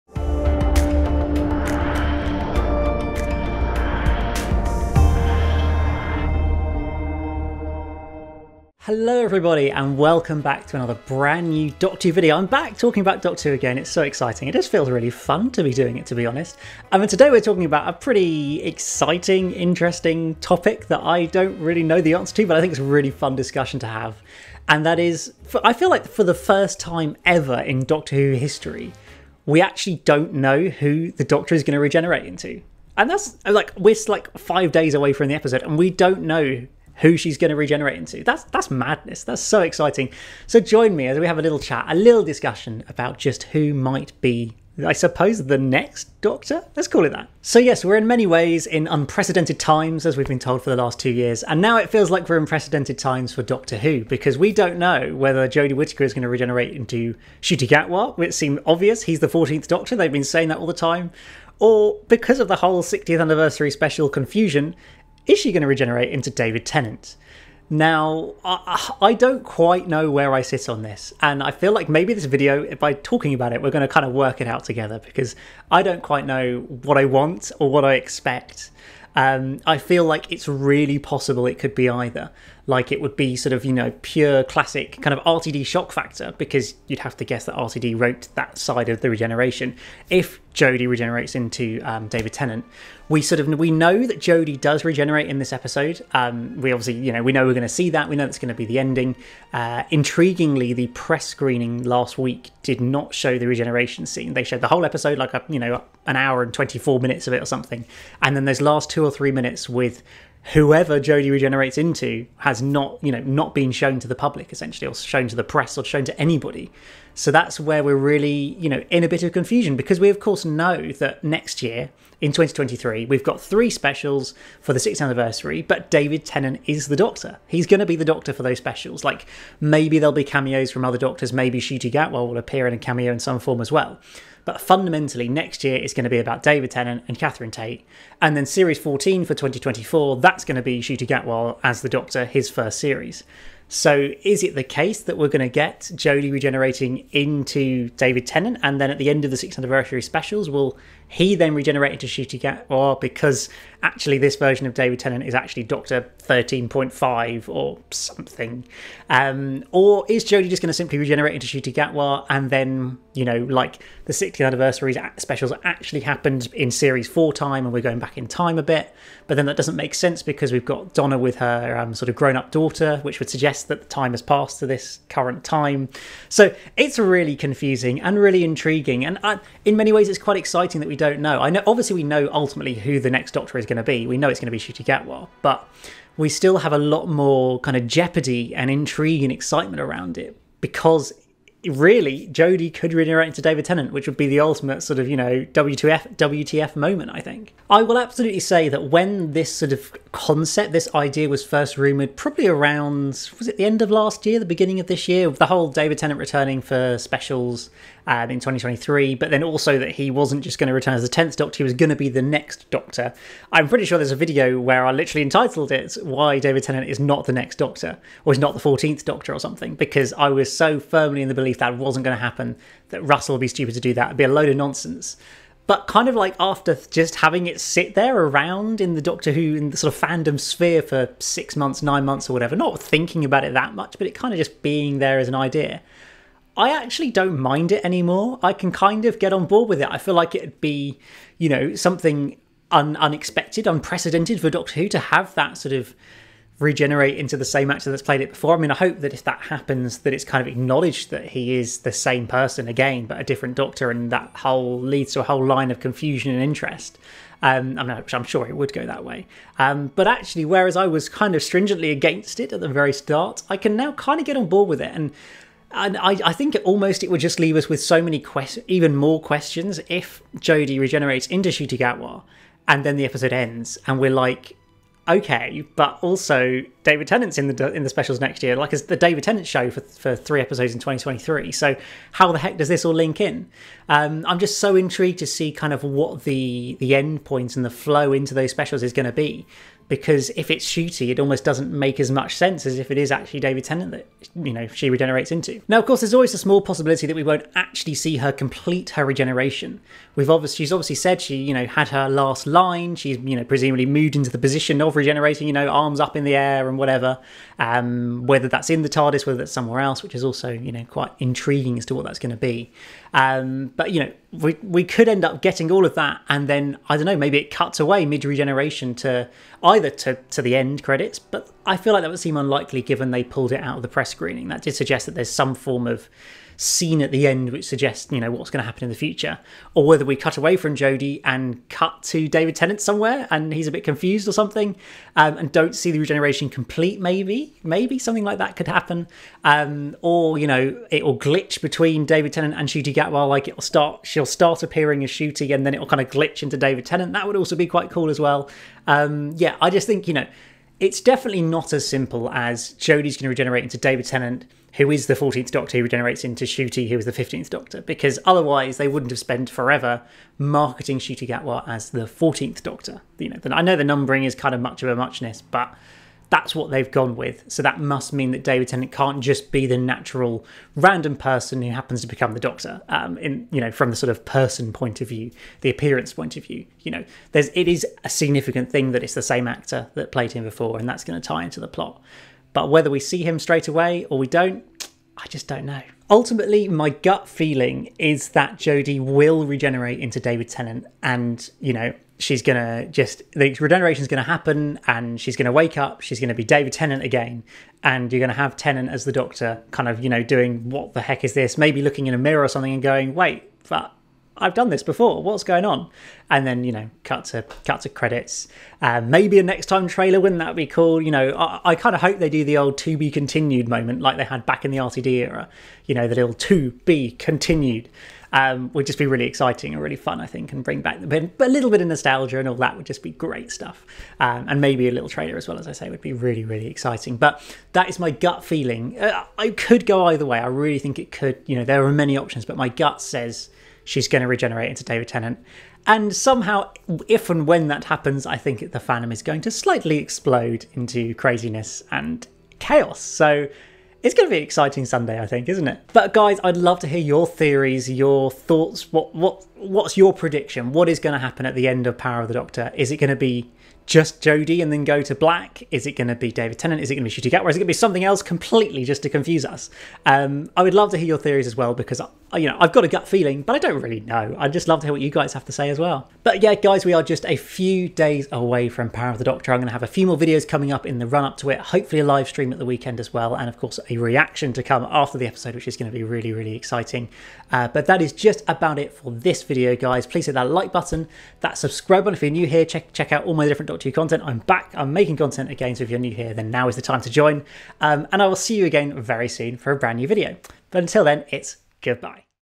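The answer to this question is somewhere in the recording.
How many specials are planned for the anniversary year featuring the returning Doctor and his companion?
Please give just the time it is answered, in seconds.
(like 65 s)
123 s.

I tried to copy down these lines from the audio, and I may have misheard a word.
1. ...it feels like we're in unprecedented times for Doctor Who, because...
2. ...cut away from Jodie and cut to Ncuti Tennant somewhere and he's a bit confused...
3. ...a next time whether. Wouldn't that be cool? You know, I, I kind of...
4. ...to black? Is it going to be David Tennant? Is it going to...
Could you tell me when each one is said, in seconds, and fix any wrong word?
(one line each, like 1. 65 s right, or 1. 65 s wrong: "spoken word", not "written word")
1. 51 s right
2. 330 s wrong: "David", not "Ncuti"
3. 409 s wrong: "trailer", not "whether"
4. 455 s right.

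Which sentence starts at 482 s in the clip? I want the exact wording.
Check check out all my different Doctor Content.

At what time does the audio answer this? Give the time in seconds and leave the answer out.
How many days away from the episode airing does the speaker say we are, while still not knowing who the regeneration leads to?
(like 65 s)
34 s.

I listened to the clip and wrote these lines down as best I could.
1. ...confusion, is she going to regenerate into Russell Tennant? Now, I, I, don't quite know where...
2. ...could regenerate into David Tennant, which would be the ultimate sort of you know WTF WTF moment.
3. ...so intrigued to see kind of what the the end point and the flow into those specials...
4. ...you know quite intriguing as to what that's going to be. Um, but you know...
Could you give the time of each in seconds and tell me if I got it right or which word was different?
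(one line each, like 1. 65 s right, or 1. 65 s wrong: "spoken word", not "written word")
1. 64 s wrong: "David", not "Russell"
2. 192 s right
3. 284 s right
4. 310 s right.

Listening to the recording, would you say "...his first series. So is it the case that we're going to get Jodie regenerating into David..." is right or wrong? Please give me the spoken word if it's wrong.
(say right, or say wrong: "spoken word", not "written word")
right.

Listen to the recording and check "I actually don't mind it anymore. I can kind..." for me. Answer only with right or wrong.
right.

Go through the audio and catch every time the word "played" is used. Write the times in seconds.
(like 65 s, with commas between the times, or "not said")
248 s, 380 s.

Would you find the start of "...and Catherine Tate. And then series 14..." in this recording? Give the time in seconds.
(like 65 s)
137 s.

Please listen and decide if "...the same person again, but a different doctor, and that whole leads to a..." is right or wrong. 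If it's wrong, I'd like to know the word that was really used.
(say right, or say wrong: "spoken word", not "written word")
right.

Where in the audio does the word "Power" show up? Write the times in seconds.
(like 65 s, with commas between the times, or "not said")
451 s, 468 s.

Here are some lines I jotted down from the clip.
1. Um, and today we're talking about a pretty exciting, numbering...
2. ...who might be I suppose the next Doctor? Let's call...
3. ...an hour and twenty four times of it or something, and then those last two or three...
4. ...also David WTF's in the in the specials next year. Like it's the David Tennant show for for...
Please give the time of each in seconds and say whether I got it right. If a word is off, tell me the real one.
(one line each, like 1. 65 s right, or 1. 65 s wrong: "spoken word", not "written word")
1. 16 s wrong: "interesting", not "numbering"
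2. 43 s right
3. 106 s wrong: "minutes", not "times"
4. 276 s wrong: "Tennant", not "WTF".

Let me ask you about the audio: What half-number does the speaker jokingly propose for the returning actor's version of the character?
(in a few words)
13.5.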